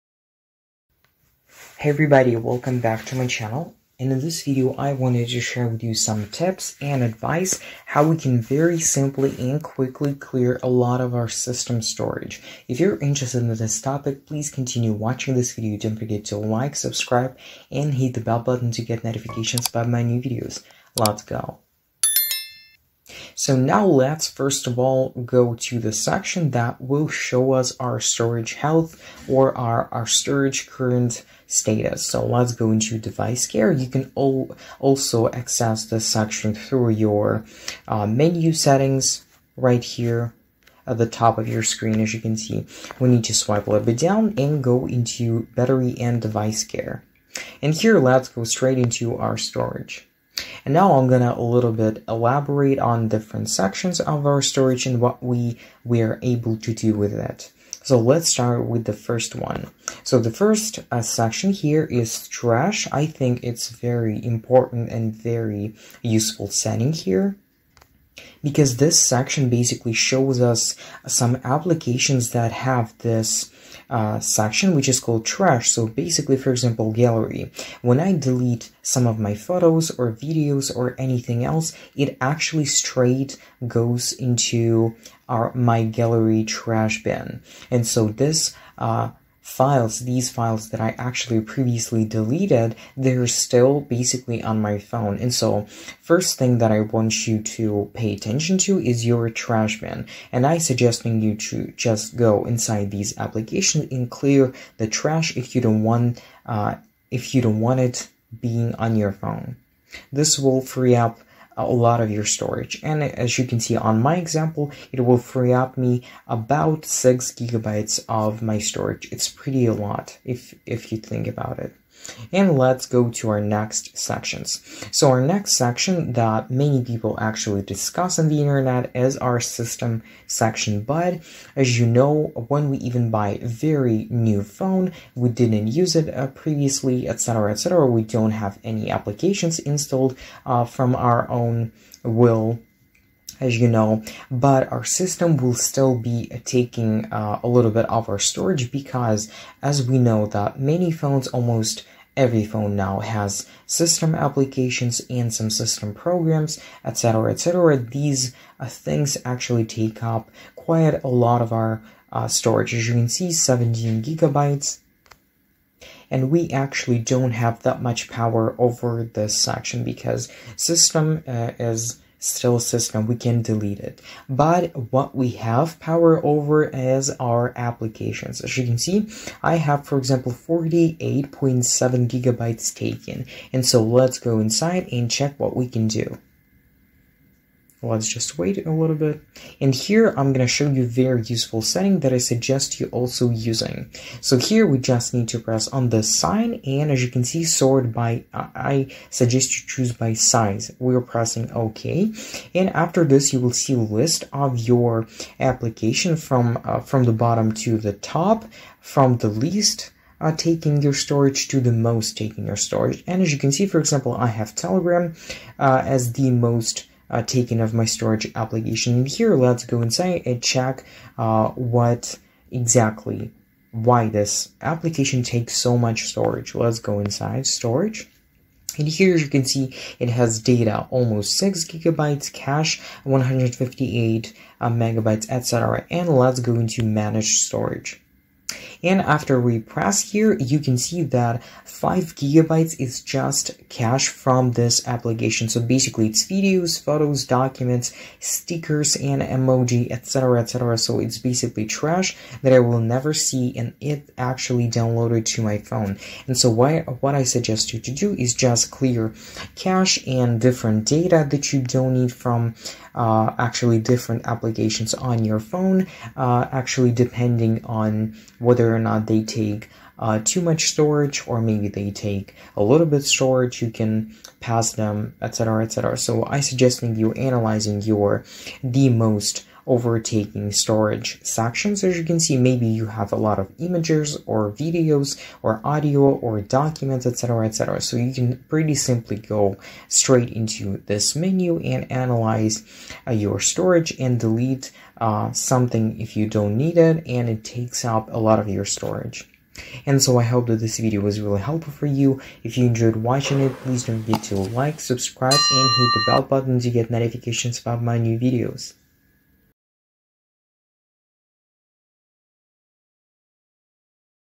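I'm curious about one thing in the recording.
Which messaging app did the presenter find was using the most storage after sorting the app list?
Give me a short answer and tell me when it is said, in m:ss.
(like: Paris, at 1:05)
Telegram, at 3:34.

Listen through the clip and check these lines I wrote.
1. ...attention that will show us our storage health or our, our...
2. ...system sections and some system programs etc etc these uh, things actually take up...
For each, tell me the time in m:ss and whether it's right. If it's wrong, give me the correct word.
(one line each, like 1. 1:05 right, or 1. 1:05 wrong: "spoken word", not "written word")
1. 0:25 wrong: "section", not "attention"
2. 2:33 wrong: "applications", not "sections".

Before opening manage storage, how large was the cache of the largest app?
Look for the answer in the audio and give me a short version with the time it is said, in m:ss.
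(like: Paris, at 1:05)
158 megabytes, at 3:53.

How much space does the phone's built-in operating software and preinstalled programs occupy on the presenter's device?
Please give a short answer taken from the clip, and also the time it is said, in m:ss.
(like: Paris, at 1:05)
17 gigabytes, at 2:43.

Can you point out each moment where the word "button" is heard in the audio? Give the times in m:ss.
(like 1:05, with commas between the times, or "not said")
0:18, 5:06.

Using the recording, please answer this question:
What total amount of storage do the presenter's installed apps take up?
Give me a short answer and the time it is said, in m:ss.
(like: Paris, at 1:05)
48.7 gigabytes, at 3:00.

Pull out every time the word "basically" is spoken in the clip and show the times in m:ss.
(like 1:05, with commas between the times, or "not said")
1:09, 1:15, 1:33, 4:05, 4:11.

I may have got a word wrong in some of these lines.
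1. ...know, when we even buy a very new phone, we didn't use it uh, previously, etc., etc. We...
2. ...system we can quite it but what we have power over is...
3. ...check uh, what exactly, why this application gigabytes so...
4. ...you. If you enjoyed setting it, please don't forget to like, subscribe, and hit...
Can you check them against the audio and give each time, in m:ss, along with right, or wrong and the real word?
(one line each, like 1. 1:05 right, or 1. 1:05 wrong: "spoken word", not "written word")
1. 2:11 right
2. 2:52 wrong: "delete", not "quite"
3. 3:40 wrong: "takes", not "gigabytes"
4. 5:01 wrong: "watching", not "setting".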